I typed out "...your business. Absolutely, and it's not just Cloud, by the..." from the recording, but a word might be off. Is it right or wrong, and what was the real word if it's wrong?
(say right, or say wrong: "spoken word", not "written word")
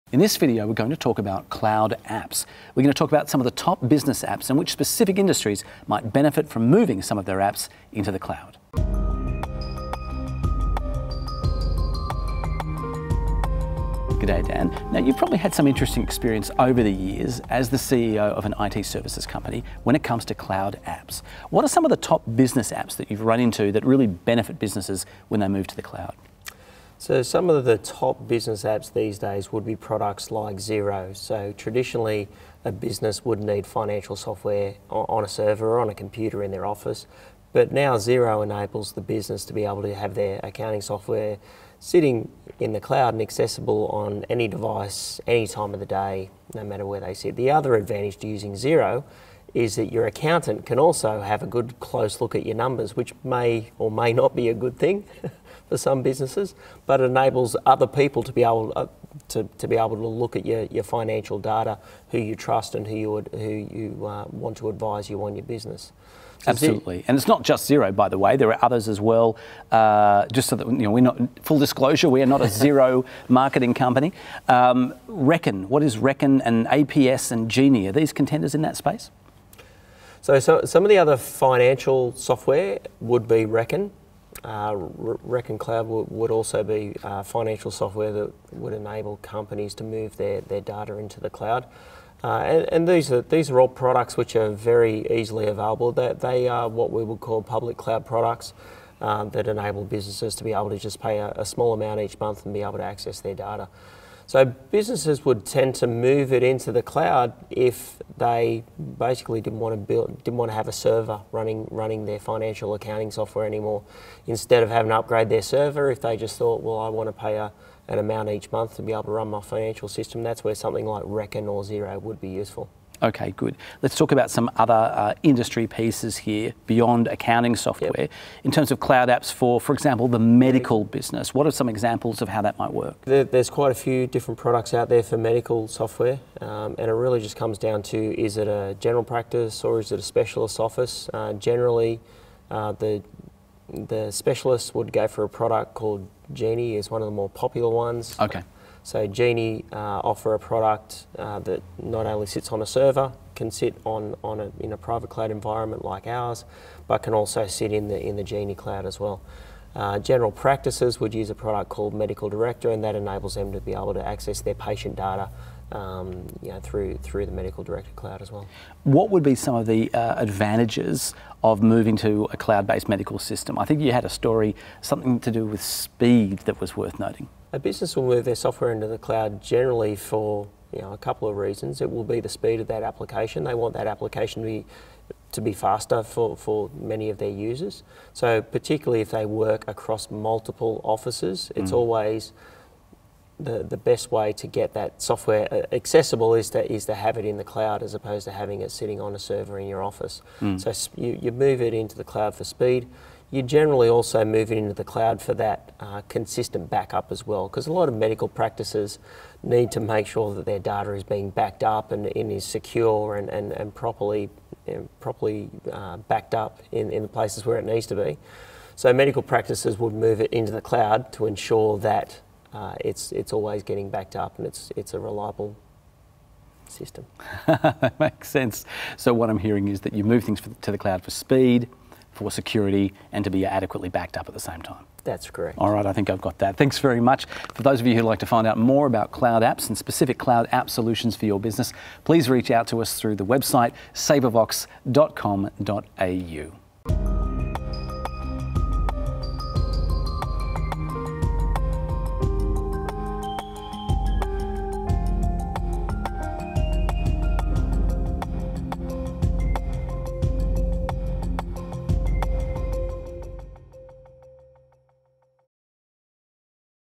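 wrong: "Xero", not "Cloud".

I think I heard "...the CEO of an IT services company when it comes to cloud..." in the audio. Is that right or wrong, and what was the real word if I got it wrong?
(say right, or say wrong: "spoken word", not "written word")
right.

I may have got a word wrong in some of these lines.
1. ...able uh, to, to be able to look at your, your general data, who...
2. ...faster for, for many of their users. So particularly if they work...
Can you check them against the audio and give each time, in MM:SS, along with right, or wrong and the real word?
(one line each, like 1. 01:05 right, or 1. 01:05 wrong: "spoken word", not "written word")
1. 00:58 wrong: "financial", not "general"
2. 03:05 right.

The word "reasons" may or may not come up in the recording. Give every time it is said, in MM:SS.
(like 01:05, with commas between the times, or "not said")
03:01.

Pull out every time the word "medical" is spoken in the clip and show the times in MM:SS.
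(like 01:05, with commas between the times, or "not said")
02:10, 02:15, 02:41, 02:47, 02:52, 03:27, 03:38.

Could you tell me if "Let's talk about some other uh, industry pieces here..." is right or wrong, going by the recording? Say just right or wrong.
right.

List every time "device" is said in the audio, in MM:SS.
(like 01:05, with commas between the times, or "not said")
00:44.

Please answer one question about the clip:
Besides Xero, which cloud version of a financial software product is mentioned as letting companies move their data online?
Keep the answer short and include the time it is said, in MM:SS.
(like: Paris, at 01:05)
Reckon Cloud, at 01:24.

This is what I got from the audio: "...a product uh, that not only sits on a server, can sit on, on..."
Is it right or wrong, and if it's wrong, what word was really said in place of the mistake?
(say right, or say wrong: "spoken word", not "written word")
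right.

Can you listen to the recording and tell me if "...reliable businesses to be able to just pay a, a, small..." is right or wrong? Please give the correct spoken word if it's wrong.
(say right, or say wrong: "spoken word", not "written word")
wrong: "enable", not "reliable".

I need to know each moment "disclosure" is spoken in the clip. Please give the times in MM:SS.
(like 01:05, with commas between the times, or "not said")
01:11.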